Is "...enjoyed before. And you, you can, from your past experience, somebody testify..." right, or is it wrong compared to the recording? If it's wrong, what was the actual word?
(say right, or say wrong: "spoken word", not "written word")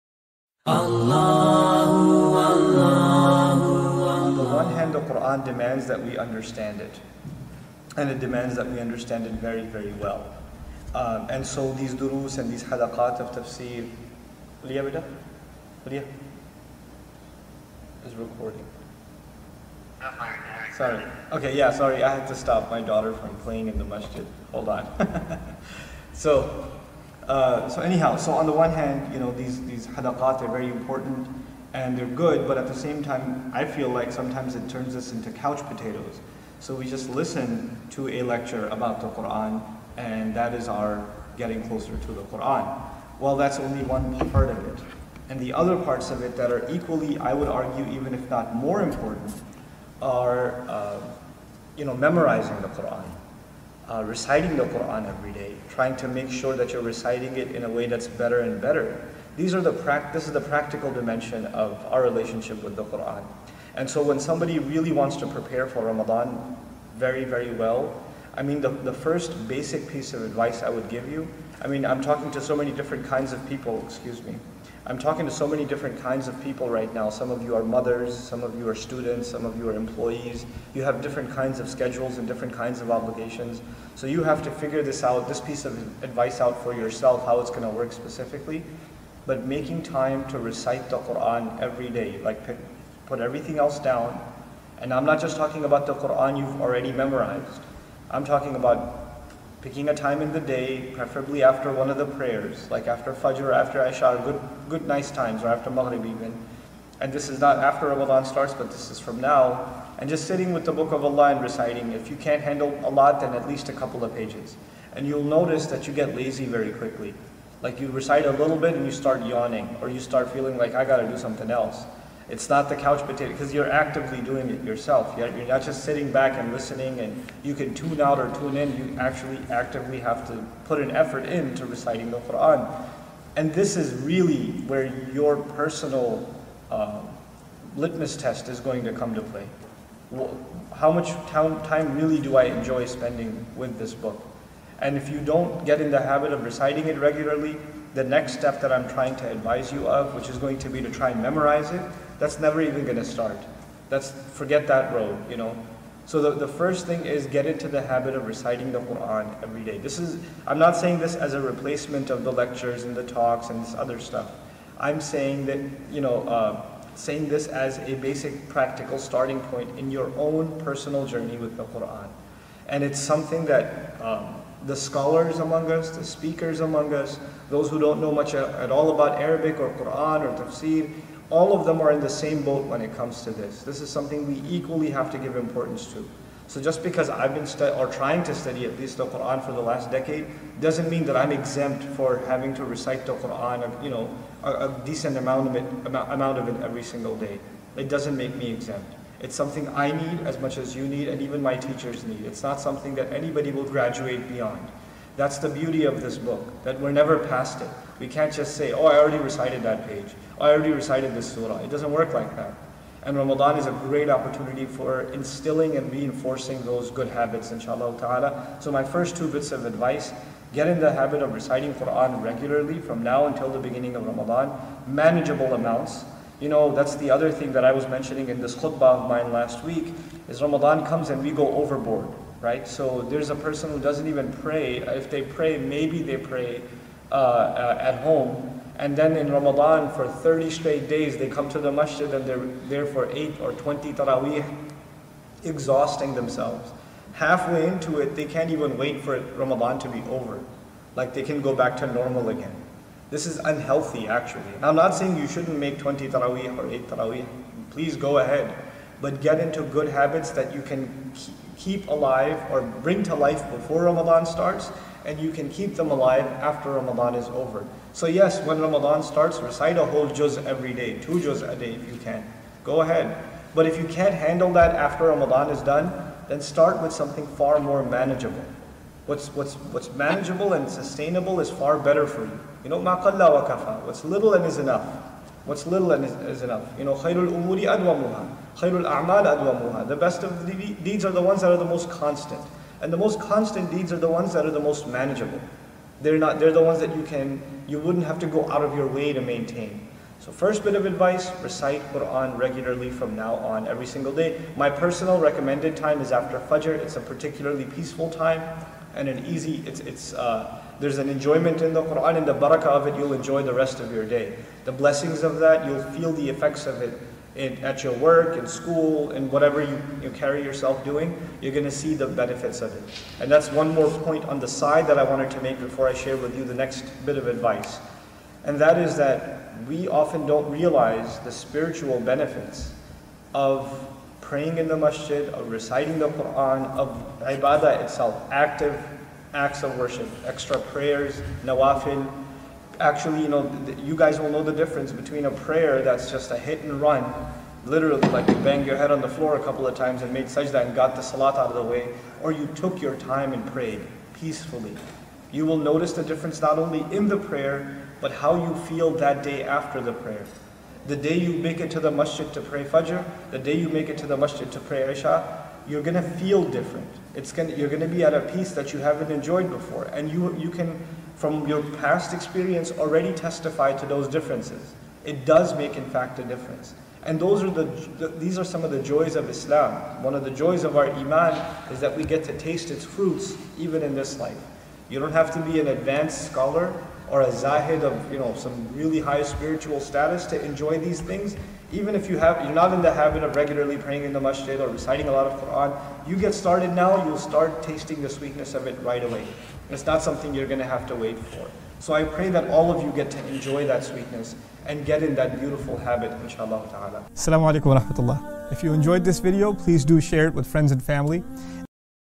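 wrong: "already", not "somebody".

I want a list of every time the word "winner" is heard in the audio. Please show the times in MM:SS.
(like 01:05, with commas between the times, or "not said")
not said.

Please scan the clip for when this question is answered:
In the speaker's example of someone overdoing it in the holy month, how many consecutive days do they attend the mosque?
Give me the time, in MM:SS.
04:00.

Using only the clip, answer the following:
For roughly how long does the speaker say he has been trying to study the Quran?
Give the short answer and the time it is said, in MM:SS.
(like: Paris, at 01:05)
the last decade, at 03:09.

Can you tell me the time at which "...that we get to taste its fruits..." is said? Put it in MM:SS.
06:21.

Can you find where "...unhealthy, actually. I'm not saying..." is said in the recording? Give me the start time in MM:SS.
04:13.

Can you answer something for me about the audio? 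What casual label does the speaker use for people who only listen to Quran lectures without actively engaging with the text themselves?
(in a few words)
couch potatoes.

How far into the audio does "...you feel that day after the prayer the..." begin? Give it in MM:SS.
05:58.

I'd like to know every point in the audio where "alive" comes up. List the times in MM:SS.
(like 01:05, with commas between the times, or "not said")
04:21, 04:25.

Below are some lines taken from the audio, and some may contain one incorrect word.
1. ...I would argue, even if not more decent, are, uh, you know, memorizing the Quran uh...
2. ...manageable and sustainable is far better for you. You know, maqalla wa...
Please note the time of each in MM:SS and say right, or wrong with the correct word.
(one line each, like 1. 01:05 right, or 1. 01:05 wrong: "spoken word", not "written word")
1. 00:47 wrong: "important", not "decent"
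2. 04:39 right.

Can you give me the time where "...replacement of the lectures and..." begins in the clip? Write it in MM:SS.
02:41.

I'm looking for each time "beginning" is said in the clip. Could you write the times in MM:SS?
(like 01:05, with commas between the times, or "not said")
03:43.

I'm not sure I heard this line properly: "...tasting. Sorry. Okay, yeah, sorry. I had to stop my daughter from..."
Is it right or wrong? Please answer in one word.
wrong.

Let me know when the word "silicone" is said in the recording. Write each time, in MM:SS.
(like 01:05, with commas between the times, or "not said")
not said.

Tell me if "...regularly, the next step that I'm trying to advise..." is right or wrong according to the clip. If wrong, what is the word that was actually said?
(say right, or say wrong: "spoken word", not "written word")
right.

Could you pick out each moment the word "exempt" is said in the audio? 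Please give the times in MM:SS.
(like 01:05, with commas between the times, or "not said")
03:11, 03:18.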